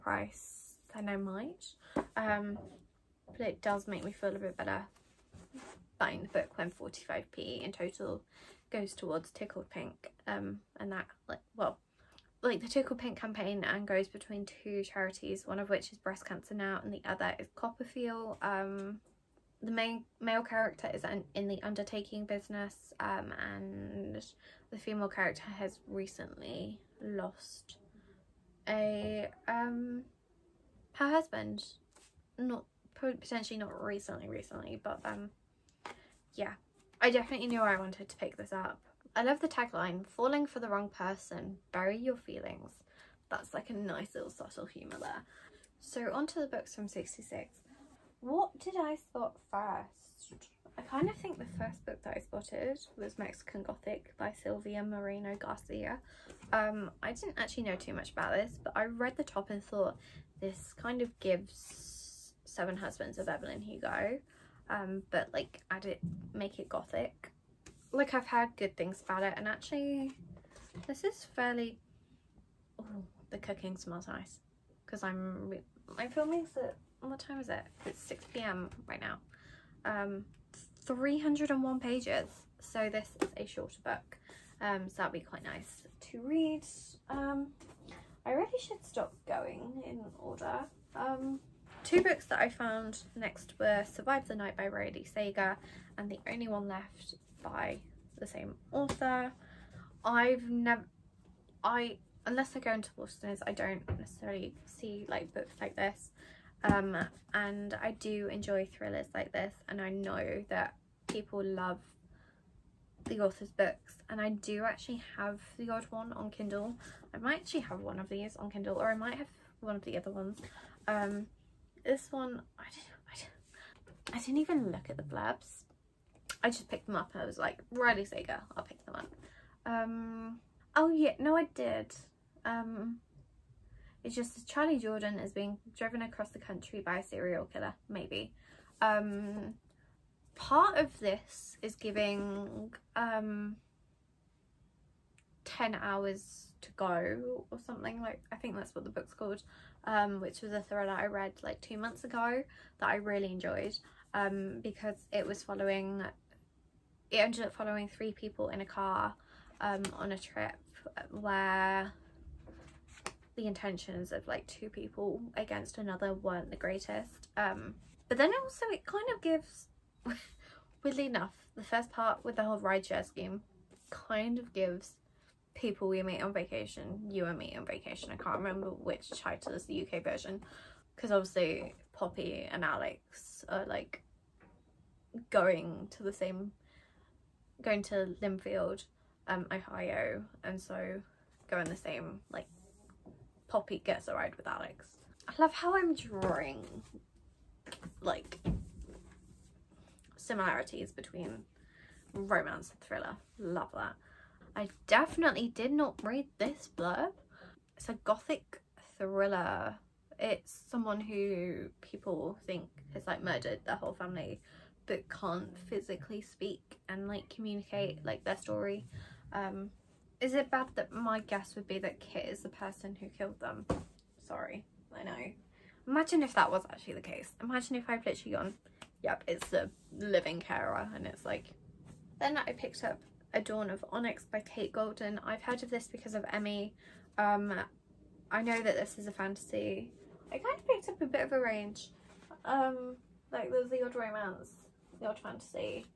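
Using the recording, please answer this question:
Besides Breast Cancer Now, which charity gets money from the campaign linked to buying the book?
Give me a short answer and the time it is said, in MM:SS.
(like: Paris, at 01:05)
CoppaFeel, at 00:17.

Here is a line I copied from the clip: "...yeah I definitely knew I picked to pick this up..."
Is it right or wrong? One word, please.
wrong.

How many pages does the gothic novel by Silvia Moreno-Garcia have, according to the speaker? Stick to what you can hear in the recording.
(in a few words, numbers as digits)
301.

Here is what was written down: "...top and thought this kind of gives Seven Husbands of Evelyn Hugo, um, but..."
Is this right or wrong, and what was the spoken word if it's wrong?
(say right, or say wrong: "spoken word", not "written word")
right.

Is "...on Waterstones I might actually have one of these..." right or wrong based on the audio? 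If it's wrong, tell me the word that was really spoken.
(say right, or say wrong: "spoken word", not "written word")
wrong: "Kindle", not "Waterstones".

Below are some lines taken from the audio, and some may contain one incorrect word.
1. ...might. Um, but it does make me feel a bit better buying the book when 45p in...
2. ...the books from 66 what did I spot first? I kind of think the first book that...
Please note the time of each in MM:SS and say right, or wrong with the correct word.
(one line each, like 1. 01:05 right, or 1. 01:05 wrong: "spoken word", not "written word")
1. 00:01 right
2. 00:46 right.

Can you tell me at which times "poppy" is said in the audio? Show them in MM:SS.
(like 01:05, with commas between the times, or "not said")
03:01, 03:13.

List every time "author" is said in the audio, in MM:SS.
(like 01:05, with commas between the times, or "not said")
01:38, 01:53.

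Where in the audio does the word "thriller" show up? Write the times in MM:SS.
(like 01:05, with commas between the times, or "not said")
01:48, 02:30, 03:22, 03:28.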